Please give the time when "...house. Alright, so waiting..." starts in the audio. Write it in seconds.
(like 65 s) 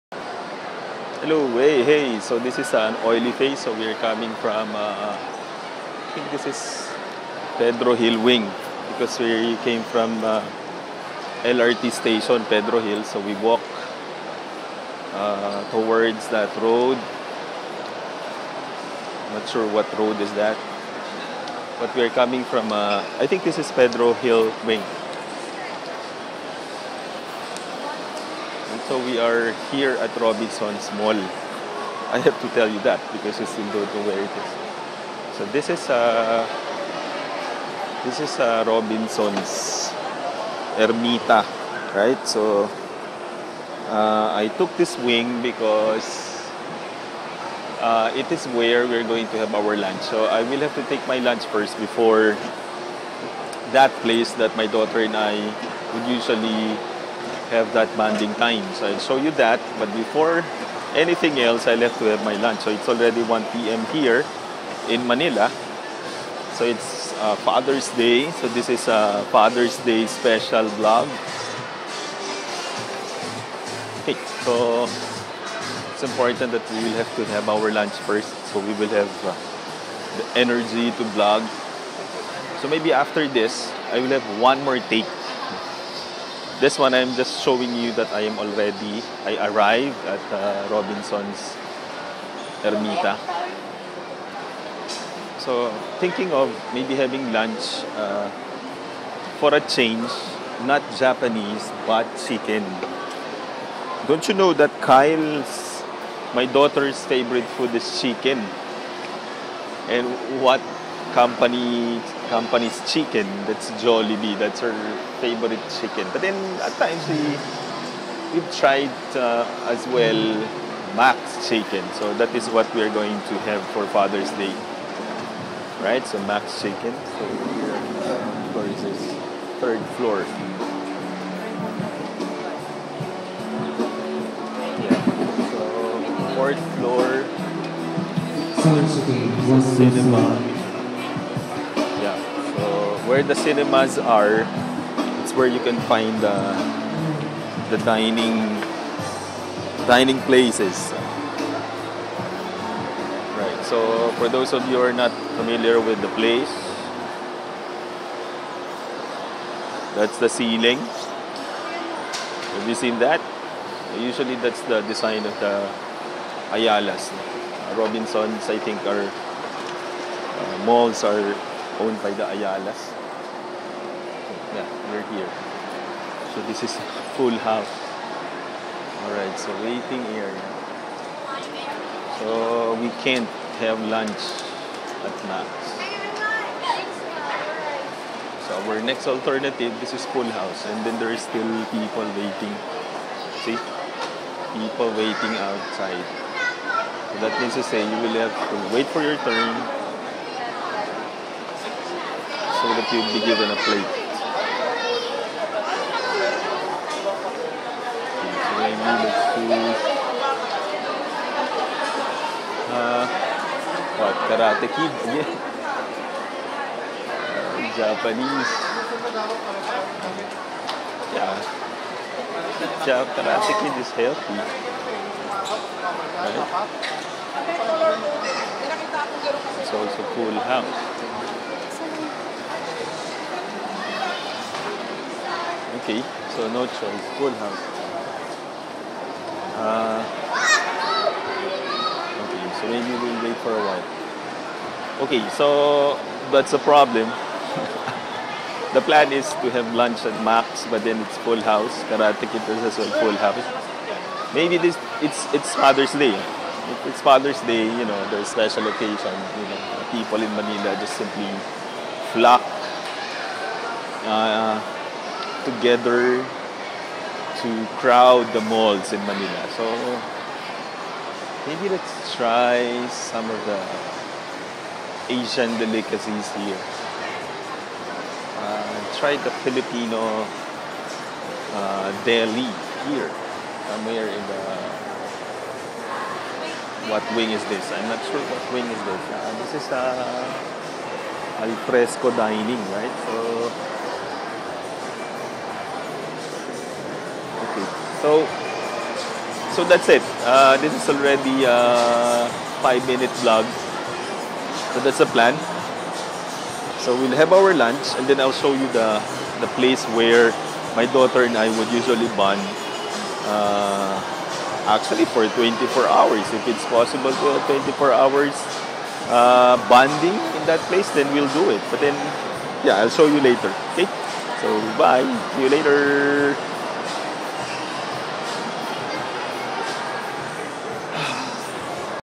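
177 s.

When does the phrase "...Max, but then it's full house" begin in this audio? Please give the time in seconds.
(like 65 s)
250 s.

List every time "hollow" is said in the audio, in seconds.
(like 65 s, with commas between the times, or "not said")
not said.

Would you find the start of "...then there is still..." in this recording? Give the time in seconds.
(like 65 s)
190 s.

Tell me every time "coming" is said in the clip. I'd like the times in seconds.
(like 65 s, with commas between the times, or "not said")
4 s, 22 s.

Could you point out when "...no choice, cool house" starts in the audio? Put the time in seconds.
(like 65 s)
236 s.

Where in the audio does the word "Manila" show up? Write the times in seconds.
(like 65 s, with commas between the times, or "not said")
65 s, 260 s, 269 s.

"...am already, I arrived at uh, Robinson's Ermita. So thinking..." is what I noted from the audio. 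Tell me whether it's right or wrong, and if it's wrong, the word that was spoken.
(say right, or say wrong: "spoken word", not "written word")
right.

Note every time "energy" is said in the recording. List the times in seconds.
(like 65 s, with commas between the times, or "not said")
80 s.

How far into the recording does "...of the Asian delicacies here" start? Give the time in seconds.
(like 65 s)
273 s.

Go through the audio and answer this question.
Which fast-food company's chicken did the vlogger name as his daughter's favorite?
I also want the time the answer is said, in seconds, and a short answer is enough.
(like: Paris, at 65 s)
Jollibee, at 113 s.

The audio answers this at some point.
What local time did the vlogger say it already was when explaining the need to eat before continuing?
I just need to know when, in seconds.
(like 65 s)
63 s.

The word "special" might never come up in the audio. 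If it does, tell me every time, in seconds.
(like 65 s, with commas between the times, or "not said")
70 s, 258 s.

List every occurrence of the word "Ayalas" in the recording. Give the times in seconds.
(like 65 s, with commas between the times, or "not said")
166 s, 172 s.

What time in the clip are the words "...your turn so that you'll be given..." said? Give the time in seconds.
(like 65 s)
199 s.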